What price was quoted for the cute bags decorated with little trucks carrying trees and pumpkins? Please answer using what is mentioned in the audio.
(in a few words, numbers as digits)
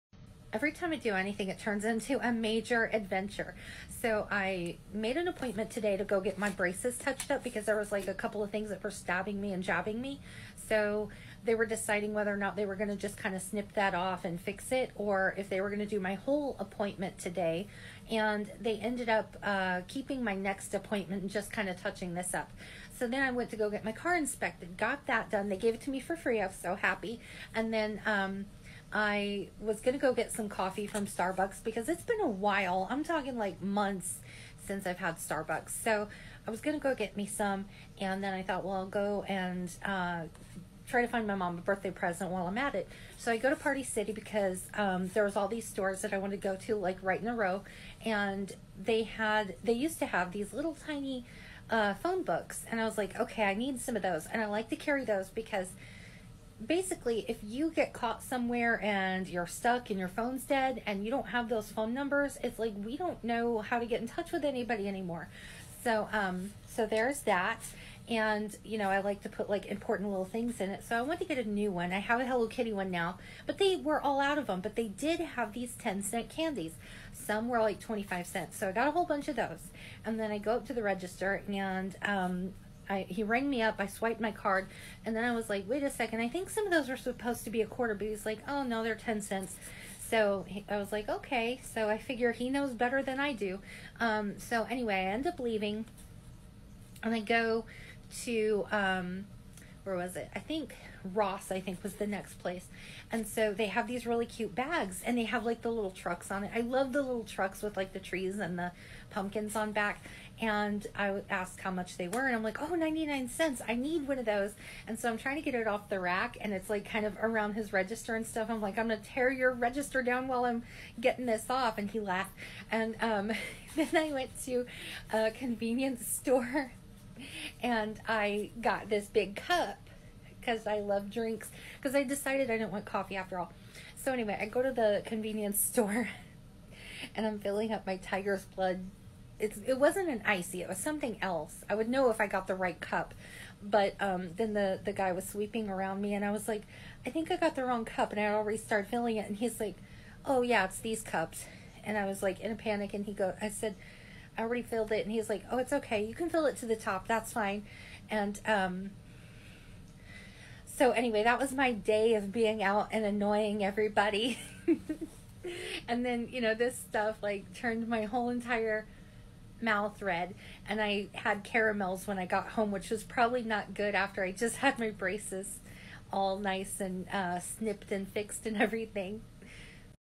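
99 cents.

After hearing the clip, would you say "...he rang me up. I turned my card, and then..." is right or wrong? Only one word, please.
wrong.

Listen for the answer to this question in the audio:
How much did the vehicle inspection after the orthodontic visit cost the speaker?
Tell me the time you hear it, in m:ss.
0:26.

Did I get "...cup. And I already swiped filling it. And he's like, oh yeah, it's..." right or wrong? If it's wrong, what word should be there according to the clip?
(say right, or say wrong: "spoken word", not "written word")
wrong: "started", not "swiped".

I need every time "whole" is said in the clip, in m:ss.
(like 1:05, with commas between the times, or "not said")
0:16, 1:18, 2:48.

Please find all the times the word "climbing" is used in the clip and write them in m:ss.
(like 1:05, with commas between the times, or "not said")
not said.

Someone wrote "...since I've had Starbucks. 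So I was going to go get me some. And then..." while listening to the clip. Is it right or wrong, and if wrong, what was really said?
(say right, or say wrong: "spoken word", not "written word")
right.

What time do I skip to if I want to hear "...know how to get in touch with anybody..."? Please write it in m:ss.
1:03.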